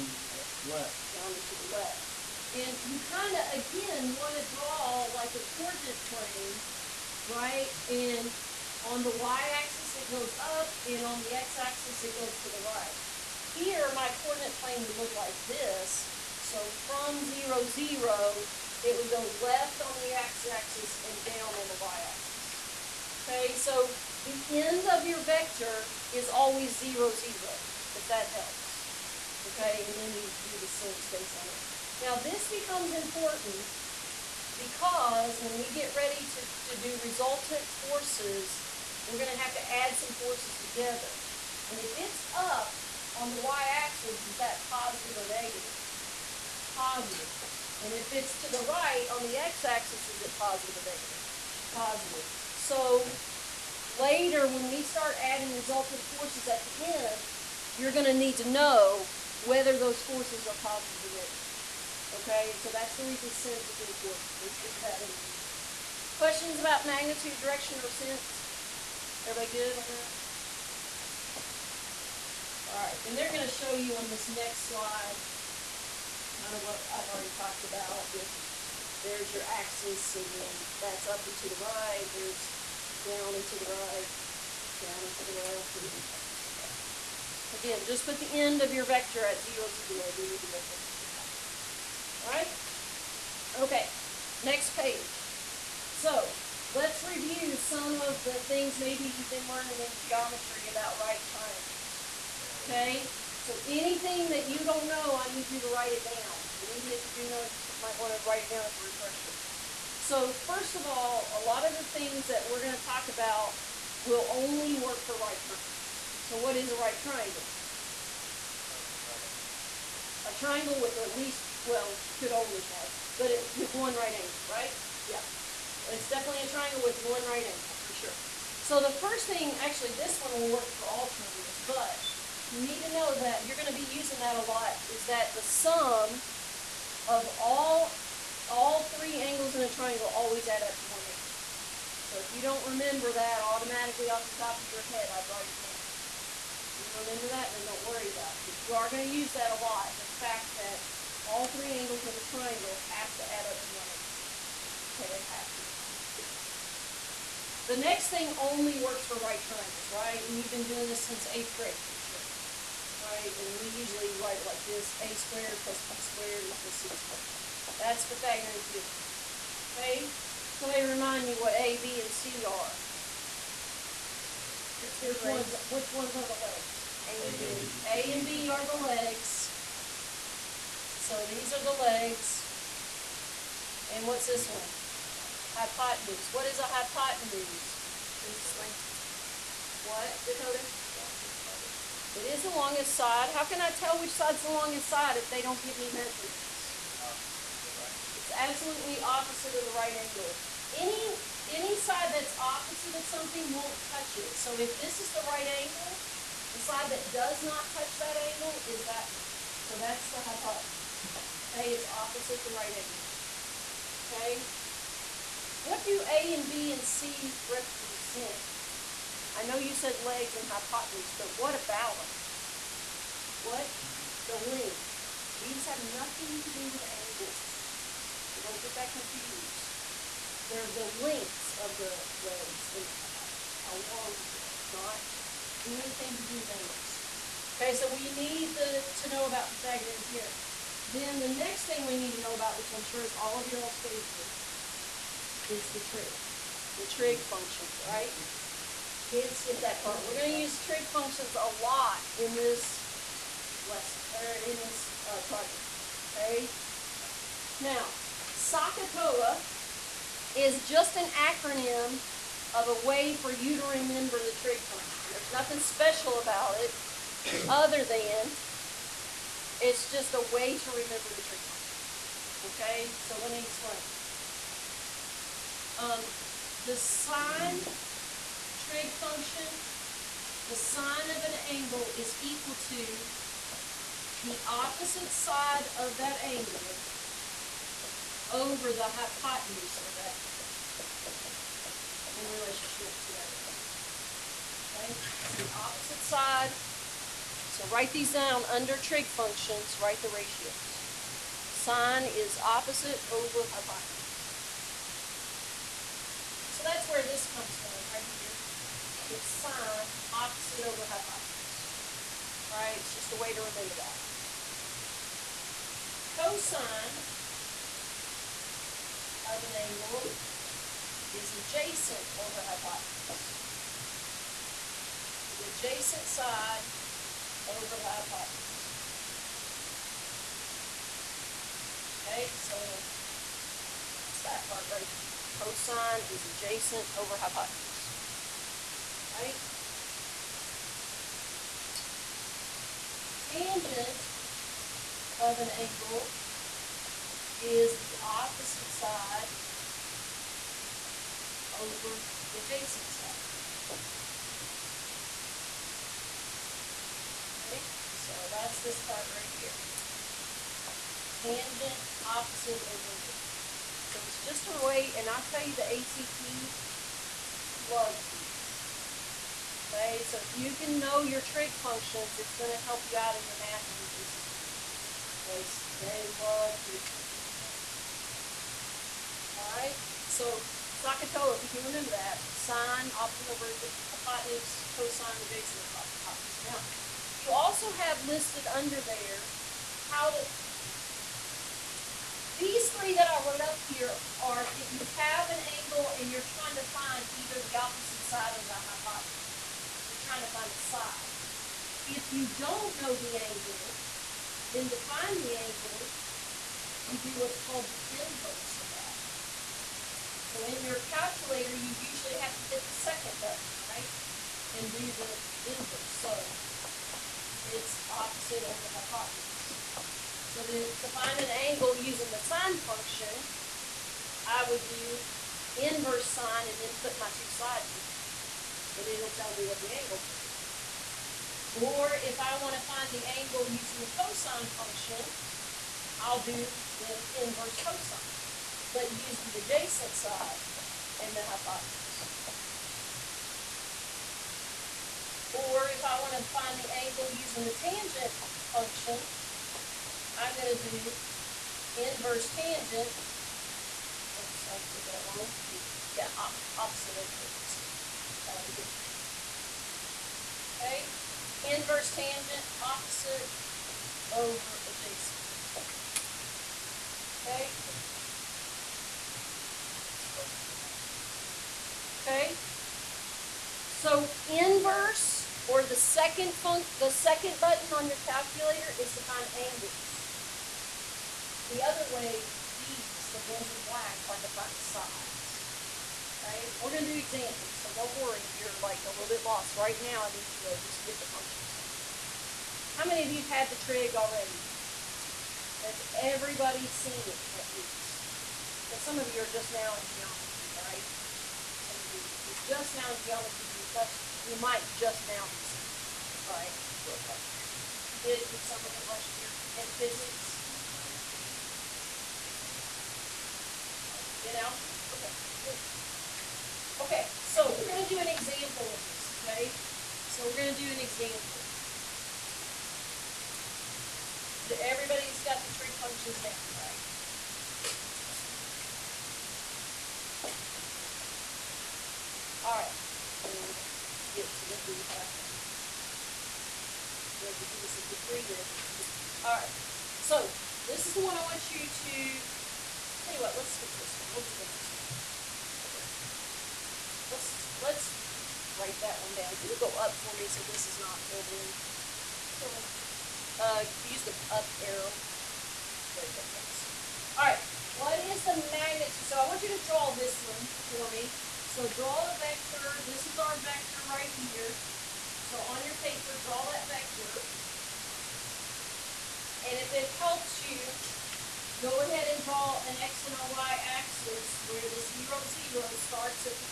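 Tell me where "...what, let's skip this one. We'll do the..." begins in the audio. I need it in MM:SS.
09:03.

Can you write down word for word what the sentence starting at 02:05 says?
It's definitely a triangle with one right angle, for sure.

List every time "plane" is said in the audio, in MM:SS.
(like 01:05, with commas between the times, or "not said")
00:06, 00:14.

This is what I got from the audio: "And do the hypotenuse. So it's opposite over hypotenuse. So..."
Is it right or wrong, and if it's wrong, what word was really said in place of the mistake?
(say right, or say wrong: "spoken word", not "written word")
wrong: "inverse", not "hypotenuse".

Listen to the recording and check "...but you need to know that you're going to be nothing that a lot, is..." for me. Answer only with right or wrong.
wrong.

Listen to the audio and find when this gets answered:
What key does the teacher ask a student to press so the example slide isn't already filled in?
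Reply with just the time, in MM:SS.
09:14.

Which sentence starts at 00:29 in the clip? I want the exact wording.
Okay, and then you do the sense based on it.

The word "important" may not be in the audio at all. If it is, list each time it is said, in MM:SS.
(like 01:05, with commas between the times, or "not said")
00:32, 01:03.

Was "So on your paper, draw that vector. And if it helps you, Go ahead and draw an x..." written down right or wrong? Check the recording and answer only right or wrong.
right.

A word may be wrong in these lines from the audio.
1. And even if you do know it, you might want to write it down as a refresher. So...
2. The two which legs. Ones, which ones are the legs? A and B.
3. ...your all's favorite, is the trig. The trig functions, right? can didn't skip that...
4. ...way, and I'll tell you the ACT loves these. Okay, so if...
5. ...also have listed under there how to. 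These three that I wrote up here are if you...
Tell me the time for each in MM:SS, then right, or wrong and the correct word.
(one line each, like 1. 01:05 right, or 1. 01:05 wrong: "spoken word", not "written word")
1. 01:46 right
2. 02:54 right
3. 04:03 right
4. 06:04 right
5. 06:27 right.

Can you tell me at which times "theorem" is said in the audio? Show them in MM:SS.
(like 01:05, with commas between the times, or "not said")
02:48, 04:00.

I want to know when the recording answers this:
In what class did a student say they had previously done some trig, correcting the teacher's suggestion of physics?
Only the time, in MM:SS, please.
08:34.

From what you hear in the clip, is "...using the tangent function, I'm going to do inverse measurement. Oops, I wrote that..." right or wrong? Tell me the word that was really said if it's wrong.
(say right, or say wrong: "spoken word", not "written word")
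wrong: "tangent", not "measurement".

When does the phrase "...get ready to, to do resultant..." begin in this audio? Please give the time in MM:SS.
00:35.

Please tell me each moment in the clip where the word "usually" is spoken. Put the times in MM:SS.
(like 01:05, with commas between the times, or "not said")
02:43, 06:51.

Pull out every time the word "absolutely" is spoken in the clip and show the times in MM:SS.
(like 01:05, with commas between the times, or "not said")
03:18.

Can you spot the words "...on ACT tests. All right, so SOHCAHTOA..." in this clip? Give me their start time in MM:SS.
06:17.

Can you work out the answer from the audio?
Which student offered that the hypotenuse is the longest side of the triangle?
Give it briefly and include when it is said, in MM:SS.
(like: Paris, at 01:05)
Dakota, at 03:10.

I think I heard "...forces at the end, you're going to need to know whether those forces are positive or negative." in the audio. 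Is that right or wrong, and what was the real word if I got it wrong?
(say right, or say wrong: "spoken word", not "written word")
right.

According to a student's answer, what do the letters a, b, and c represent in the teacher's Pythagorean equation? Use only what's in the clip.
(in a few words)
The length.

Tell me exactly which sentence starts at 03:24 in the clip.
So if this is the right angle, the side that does not touch that angle is that one.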